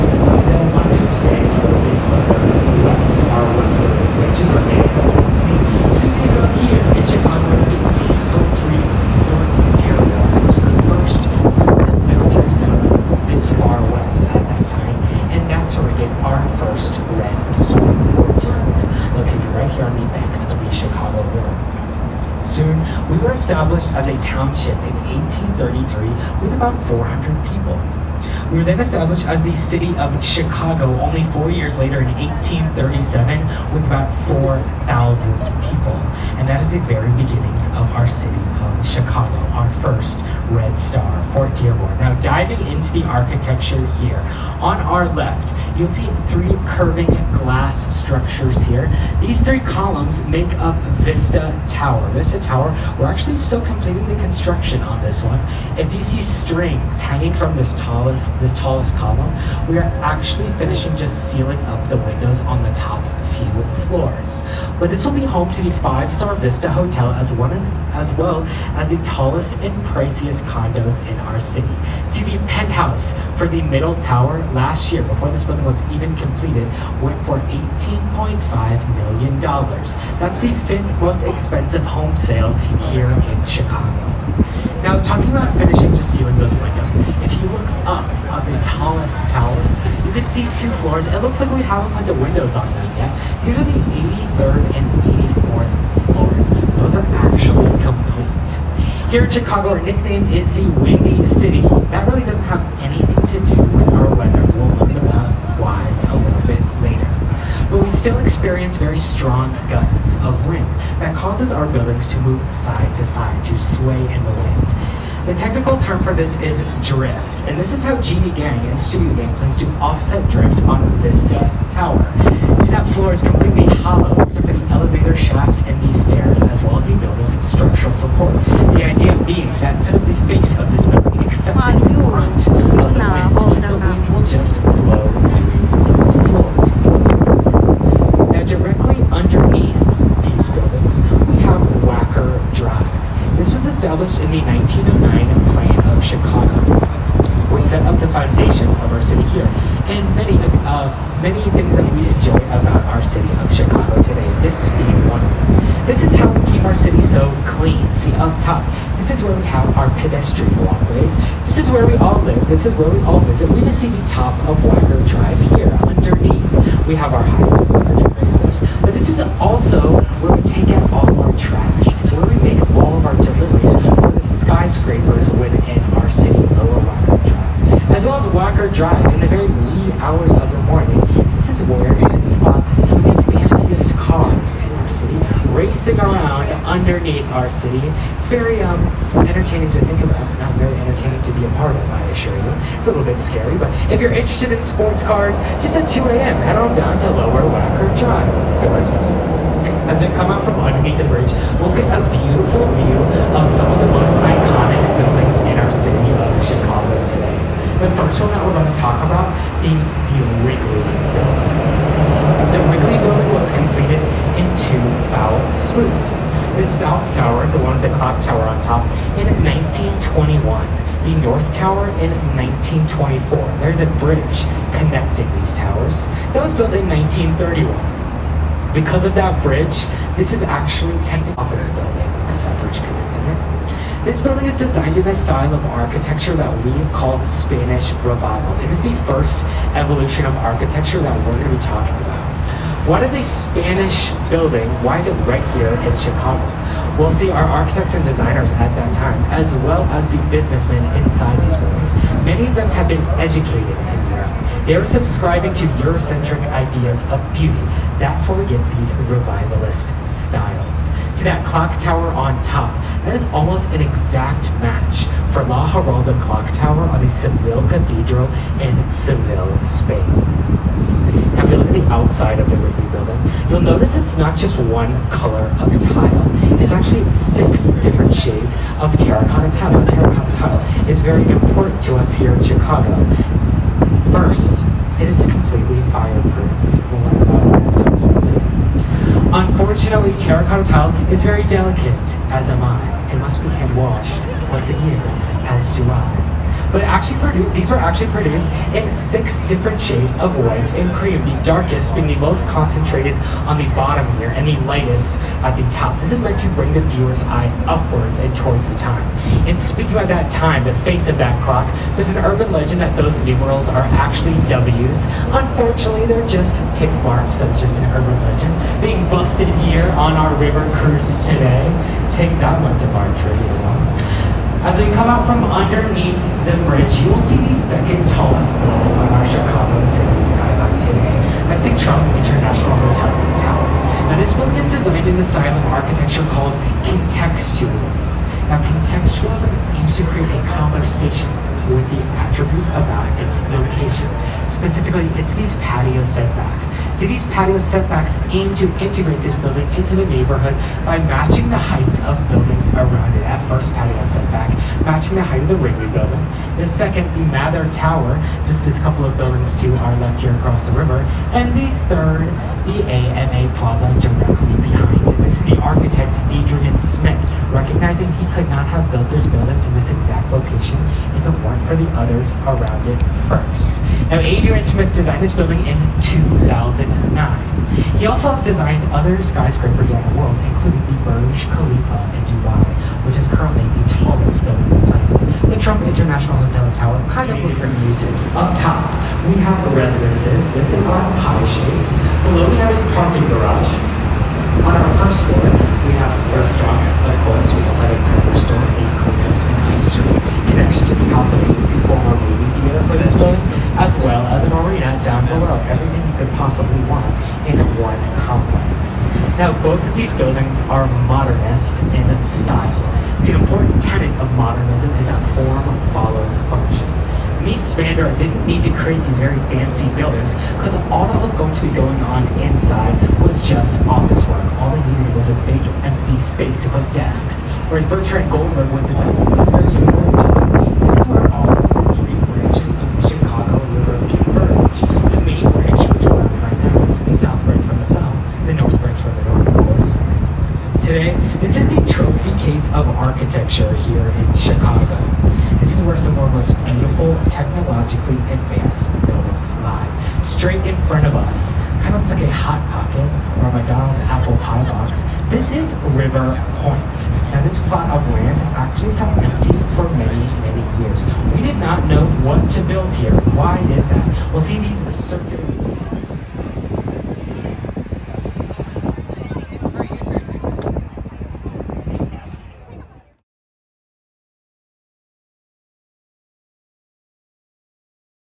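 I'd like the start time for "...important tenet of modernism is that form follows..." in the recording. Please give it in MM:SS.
06:53.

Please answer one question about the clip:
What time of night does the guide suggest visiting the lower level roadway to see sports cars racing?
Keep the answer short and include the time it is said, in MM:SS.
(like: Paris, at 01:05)
2 a.m., at 03:15.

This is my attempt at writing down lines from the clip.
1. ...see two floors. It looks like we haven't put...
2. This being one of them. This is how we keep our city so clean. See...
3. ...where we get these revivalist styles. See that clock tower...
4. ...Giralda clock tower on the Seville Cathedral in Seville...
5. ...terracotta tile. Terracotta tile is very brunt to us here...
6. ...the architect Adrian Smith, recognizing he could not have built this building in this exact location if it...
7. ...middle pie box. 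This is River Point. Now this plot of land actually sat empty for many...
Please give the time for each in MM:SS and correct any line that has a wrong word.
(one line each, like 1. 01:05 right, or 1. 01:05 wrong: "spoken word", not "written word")
1. 01:30 right
2. 02:34 right
3. 04:18 right
4. 04:25 right
5. 04:38 wrong: "important", not "brunt"
6. 06:05 right
7. 07:34 wrong: "apple", not "middle".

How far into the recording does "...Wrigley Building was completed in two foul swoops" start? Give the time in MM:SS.
03:32.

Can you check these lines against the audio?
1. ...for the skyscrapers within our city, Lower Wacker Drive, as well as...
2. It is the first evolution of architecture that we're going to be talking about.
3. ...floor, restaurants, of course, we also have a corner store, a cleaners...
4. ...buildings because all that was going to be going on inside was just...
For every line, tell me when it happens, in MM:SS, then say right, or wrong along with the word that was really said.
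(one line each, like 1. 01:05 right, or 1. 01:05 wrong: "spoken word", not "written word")
1. 02:53 right
2. 03:58 right
3. 06:35 right
4. 06:59 right.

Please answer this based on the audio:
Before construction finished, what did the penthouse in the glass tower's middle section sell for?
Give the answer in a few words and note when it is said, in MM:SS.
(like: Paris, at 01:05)
$18.5 million, at 01:17.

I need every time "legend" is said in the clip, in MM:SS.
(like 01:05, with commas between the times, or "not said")
05:12, 05:18.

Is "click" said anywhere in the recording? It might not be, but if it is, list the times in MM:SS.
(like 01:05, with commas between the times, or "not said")
not said.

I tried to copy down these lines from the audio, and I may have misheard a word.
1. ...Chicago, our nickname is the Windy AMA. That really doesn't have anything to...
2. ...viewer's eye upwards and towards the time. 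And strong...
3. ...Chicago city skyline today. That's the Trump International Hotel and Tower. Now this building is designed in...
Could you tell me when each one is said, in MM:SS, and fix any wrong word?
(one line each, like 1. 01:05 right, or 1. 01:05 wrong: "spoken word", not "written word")
1. 01:39 wrong: "City", not "AMA"
2. 05:06 wrong: "speaking", not "strong"
3. 05:29 right.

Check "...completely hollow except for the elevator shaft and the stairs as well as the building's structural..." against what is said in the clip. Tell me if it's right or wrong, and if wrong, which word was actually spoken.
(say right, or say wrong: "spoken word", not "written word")
right.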